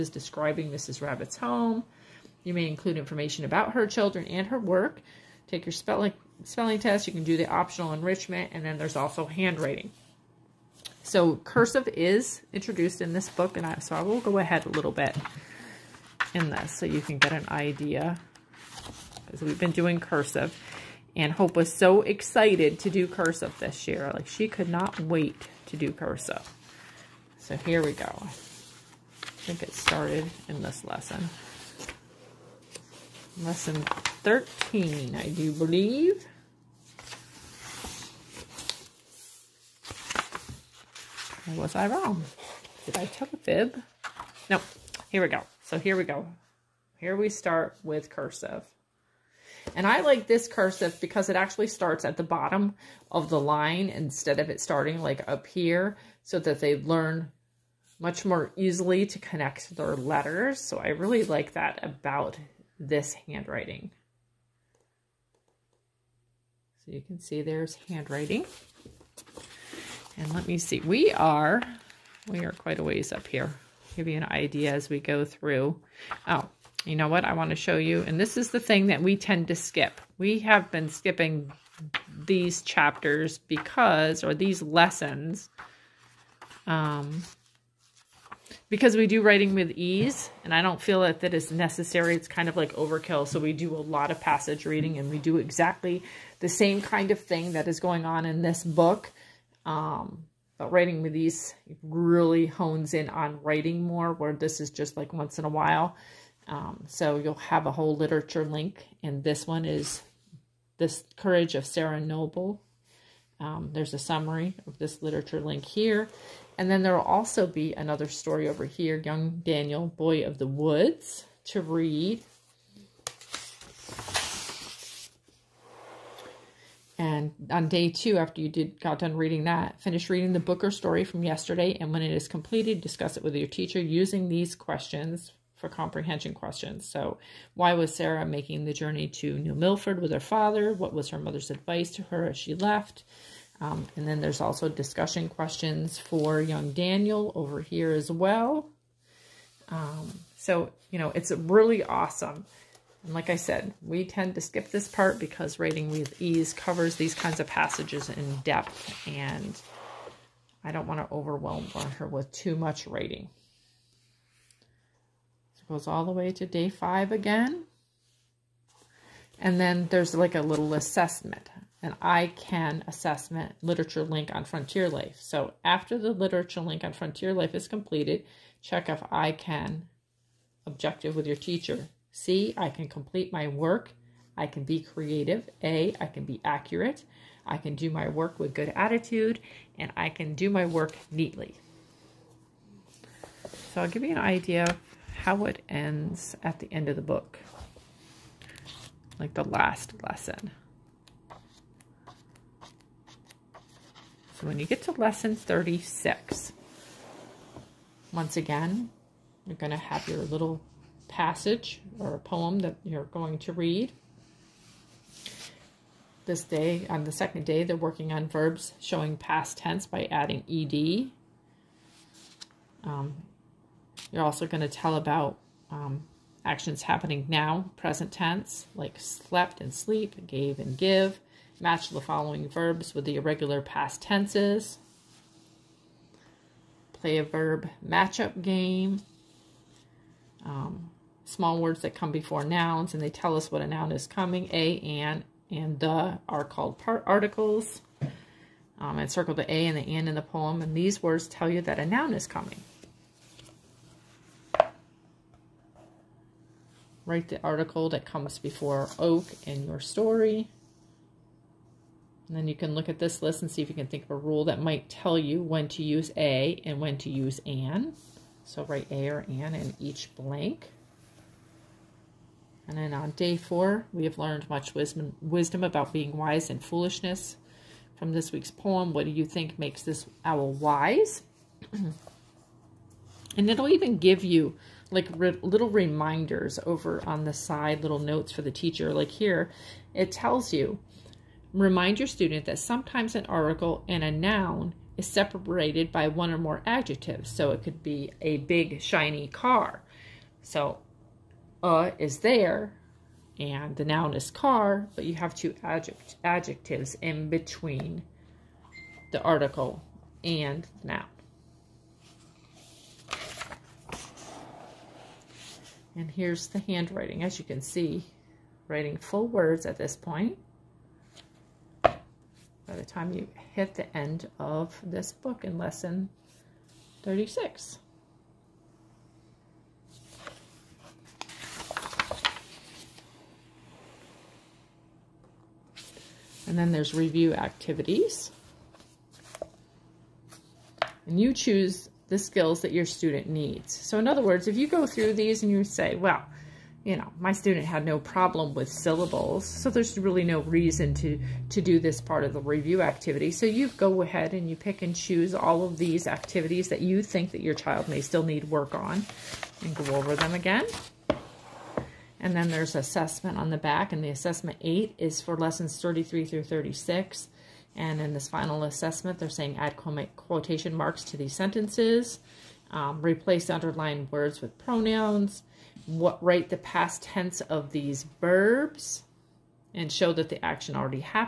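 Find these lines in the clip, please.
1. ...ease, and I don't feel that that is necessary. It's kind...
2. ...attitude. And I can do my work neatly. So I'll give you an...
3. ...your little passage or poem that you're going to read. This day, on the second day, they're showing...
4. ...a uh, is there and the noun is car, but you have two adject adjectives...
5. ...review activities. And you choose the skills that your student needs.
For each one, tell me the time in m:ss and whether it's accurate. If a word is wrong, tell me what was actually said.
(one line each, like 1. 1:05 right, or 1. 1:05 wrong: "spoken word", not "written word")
1. 1:29 right
2. 3:08 right
3. 3:30 wrong: "working", not "showing"
4. 5:01 right
5. 5:36 right.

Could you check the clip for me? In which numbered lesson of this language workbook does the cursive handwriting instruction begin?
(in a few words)
13.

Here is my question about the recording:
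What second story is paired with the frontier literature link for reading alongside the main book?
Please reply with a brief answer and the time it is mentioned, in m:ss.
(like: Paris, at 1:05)
Young Daniel, Boy of the Woods, at 1:59.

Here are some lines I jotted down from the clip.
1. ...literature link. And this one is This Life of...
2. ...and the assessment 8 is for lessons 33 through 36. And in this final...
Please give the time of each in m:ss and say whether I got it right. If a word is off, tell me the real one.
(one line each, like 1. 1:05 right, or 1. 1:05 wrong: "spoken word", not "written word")
1. 1:47 wrong: "Courage", not "Life"
2. 6:03 right.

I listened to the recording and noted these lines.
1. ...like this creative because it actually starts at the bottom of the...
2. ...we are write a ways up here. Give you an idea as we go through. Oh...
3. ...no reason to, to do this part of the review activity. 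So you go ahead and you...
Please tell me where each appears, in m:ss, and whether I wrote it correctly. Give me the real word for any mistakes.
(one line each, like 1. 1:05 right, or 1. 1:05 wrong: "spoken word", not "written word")
1. 0:50 wrong: "cursive", not "creative"
2. 1:12 wrong: "quite", not "write"
3. 5:50 right.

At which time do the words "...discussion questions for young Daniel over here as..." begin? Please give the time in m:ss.
2:24.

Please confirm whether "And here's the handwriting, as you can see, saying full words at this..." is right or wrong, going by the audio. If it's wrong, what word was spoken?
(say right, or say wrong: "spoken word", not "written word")
wrong: "writing", not "saying".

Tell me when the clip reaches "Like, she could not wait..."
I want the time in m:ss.
0:24.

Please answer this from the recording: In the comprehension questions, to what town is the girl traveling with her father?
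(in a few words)
New Milford.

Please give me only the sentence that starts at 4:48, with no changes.
Like here, it tells you, remind your student that sometimes an article and a noun is separated by one or more adjectives.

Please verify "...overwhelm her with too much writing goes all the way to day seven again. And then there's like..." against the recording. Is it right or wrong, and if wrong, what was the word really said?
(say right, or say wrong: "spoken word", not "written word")
wrong: "five", not "seven".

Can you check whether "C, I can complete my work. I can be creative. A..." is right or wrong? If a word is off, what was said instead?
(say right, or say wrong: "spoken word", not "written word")
right.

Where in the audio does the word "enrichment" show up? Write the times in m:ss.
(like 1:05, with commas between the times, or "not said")
0:07.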